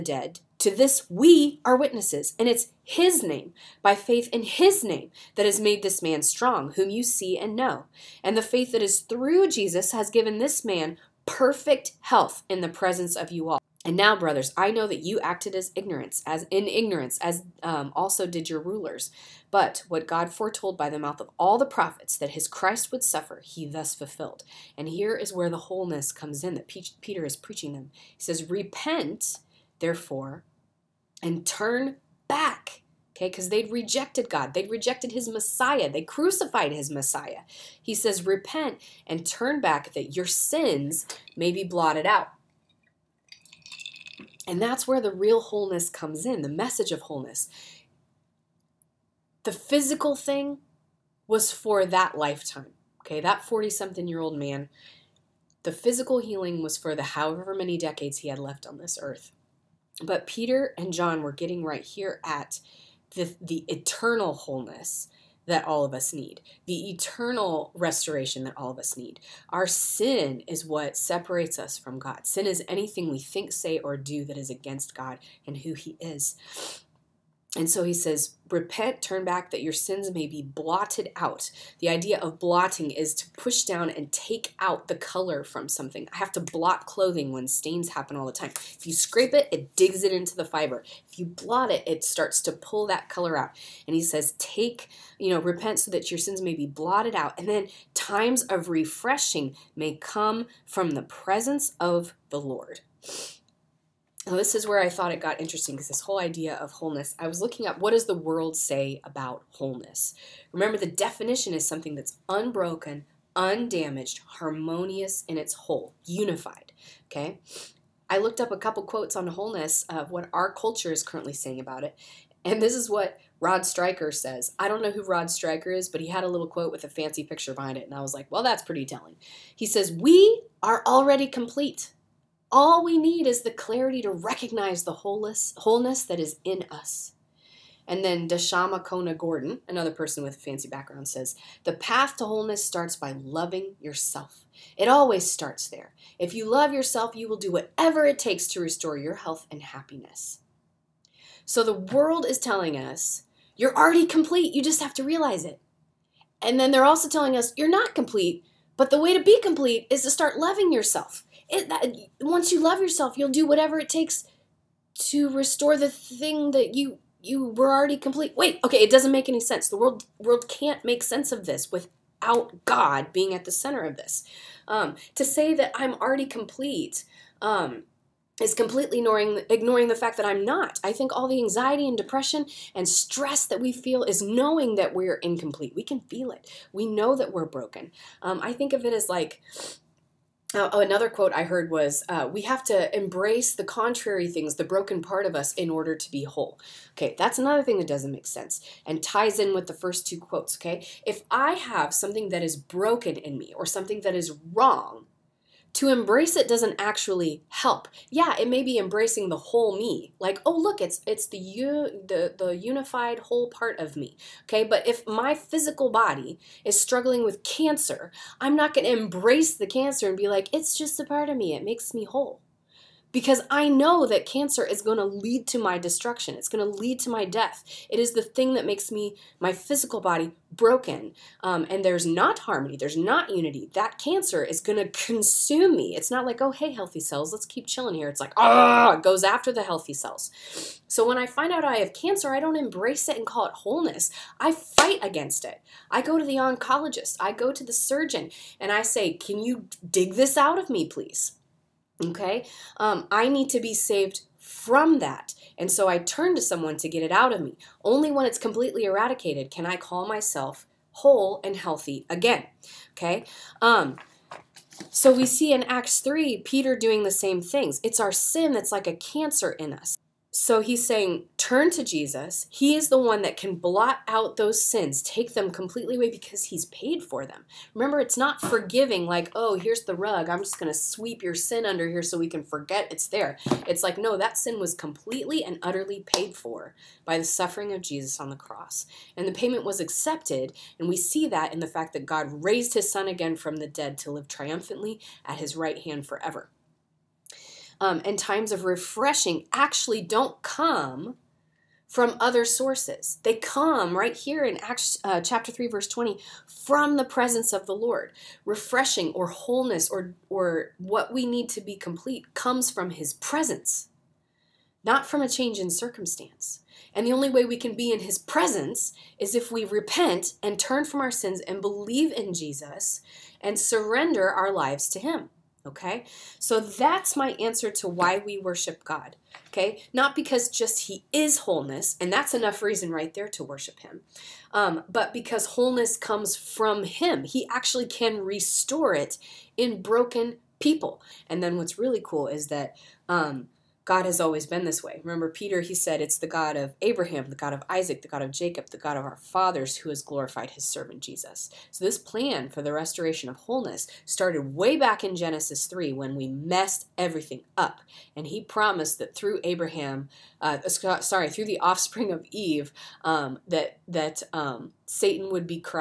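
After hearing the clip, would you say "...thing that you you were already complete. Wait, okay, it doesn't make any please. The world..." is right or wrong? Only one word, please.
wrong.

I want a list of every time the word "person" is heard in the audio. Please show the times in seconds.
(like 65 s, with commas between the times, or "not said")
139 s.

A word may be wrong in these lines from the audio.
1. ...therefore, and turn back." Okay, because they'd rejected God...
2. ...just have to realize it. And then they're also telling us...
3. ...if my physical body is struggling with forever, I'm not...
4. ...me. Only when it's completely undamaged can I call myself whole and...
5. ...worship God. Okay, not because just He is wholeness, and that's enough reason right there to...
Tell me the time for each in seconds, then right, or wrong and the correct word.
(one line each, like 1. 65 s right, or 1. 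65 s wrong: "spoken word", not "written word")
1. 29 s right
2. 154 s right
3. 214 s wrong: "cancer", not "forever"
4. 257 s wrong: "eradicated", not "undamaged"
5. 328 s right.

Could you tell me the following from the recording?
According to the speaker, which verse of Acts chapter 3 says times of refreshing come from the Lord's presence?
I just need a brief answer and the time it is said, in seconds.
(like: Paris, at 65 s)
20, at 305 s.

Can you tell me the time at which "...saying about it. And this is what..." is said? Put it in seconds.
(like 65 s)
121 s.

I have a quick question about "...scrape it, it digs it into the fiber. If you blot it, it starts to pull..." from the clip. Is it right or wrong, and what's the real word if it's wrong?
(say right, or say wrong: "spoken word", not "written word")
right.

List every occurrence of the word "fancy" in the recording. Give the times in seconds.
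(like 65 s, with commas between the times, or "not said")
126 s, 140 s.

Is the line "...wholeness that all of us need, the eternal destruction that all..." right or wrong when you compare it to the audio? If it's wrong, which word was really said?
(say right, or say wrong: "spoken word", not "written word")
wrong: "restoration", not "destruction".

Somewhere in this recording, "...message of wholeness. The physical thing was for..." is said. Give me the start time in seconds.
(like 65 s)
46 s.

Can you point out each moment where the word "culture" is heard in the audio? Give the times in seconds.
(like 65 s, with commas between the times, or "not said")
120 s.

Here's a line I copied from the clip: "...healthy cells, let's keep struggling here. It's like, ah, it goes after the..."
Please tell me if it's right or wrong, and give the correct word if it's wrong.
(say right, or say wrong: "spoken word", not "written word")
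wrong: "chilling", not "struggling".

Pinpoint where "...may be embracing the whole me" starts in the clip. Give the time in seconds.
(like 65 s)
208 s.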